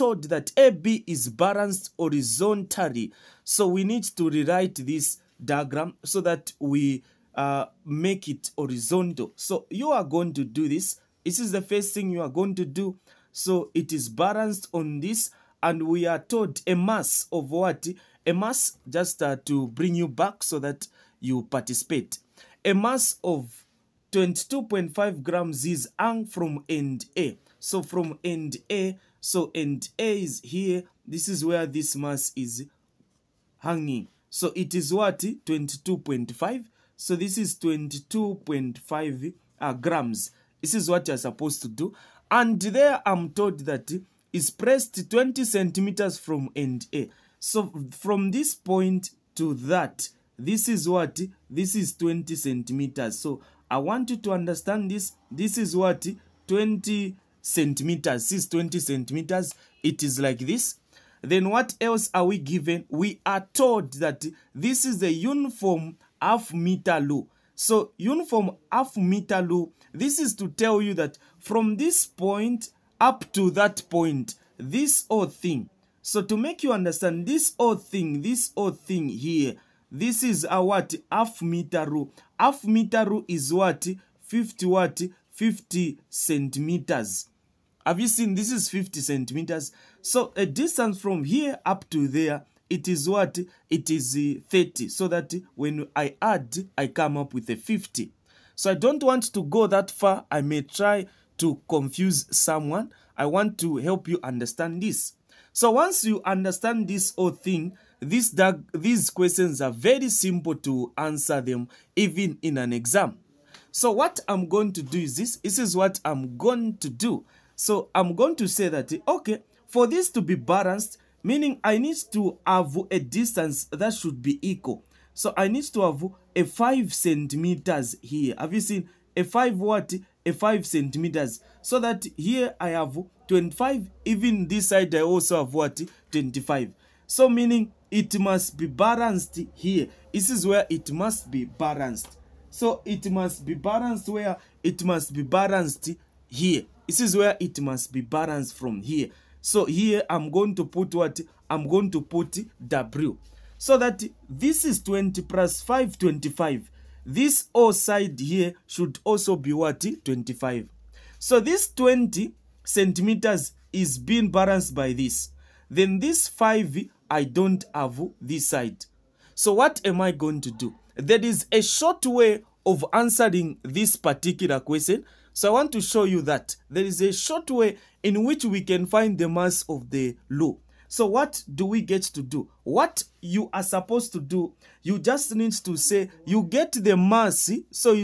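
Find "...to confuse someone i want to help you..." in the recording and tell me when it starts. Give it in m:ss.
1:41.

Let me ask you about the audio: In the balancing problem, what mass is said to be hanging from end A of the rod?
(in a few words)
22.5 grams.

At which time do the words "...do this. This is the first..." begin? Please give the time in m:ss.
0:10.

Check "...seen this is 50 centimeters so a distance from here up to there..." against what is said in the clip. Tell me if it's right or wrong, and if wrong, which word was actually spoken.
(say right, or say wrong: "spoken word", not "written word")
right.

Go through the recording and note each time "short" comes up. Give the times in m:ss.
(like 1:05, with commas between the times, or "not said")
2:51, 2:57.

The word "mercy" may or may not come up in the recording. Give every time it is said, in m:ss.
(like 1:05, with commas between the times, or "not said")
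3:06.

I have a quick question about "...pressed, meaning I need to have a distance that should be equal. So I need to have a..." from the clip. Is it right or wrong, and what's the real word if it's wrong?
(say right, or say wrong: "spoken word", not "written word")
wrong: "balanced", not "pressed".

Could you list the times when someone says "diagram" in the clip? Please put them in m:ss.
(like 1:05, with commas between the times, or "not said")
0:05.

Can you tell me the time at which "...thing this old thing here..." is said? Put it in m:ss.
1:17.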